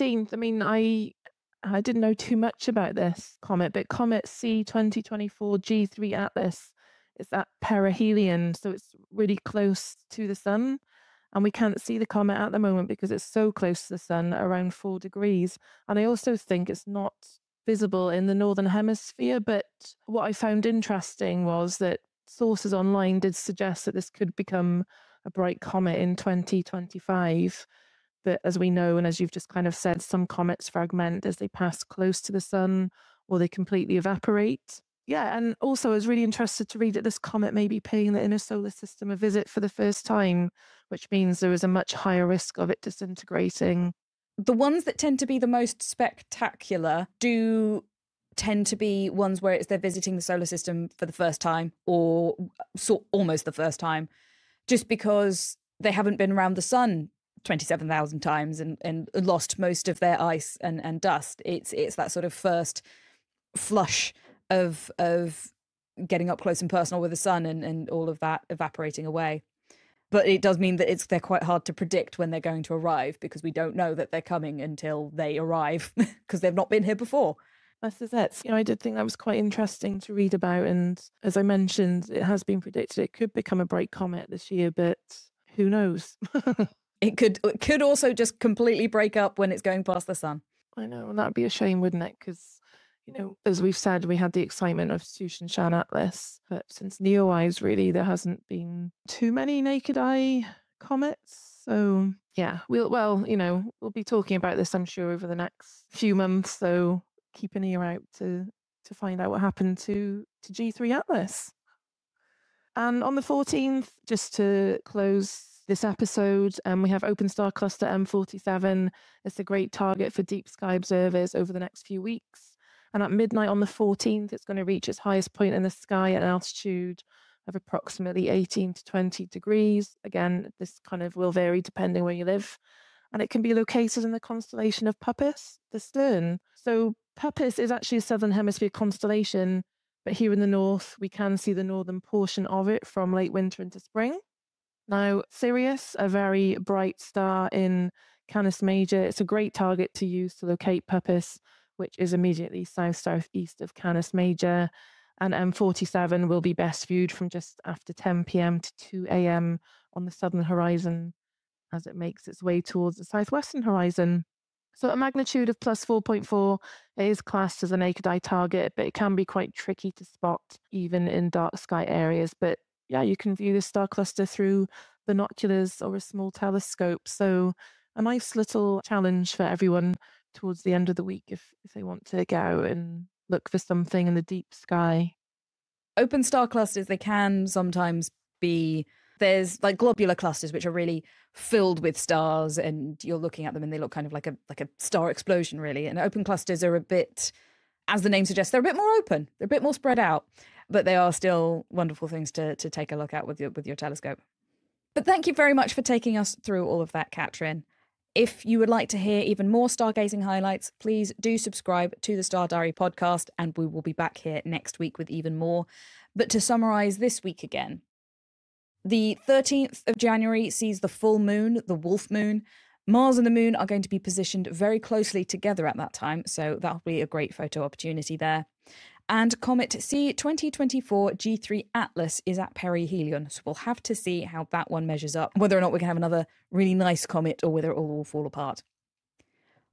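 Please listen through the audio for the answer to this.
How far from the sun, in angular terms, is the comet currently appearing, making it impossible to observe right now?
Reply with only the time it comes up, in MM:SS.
00:14.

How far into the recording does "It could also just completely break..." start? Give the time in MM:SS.
01:27.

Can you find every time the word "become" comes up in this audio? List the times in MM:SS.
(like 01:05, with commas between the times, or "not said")
00:24, 01:23.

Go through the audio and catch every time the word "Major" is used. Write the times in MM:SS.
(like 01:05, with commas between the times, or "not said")
02:28, 02:34.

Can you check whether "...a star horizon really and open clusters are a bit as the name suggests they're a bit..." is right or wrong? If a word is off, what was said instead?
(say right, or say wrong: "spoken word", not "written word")
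wrong: "explosion", not "horizon".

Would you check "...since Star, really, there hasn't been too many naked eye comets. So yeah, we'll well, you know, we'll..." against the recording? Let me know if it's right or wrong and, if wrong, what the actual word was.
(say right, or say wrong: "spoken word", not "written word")
wrong: "NEOWISE", not "Star".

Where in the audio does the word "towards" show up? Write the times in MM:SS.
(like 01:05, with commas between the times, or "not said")
02:42, 03:00.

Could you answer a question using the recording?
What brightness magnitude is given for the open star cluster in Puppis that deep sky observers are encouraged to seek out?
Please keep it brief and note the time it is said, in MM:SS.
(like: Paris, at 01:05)
+4.4, at 02:45.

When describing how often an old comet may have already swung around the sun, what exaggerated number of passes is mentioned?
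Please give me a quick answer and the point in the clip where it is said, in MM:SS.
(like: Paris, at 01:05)
27,000, at 00:57.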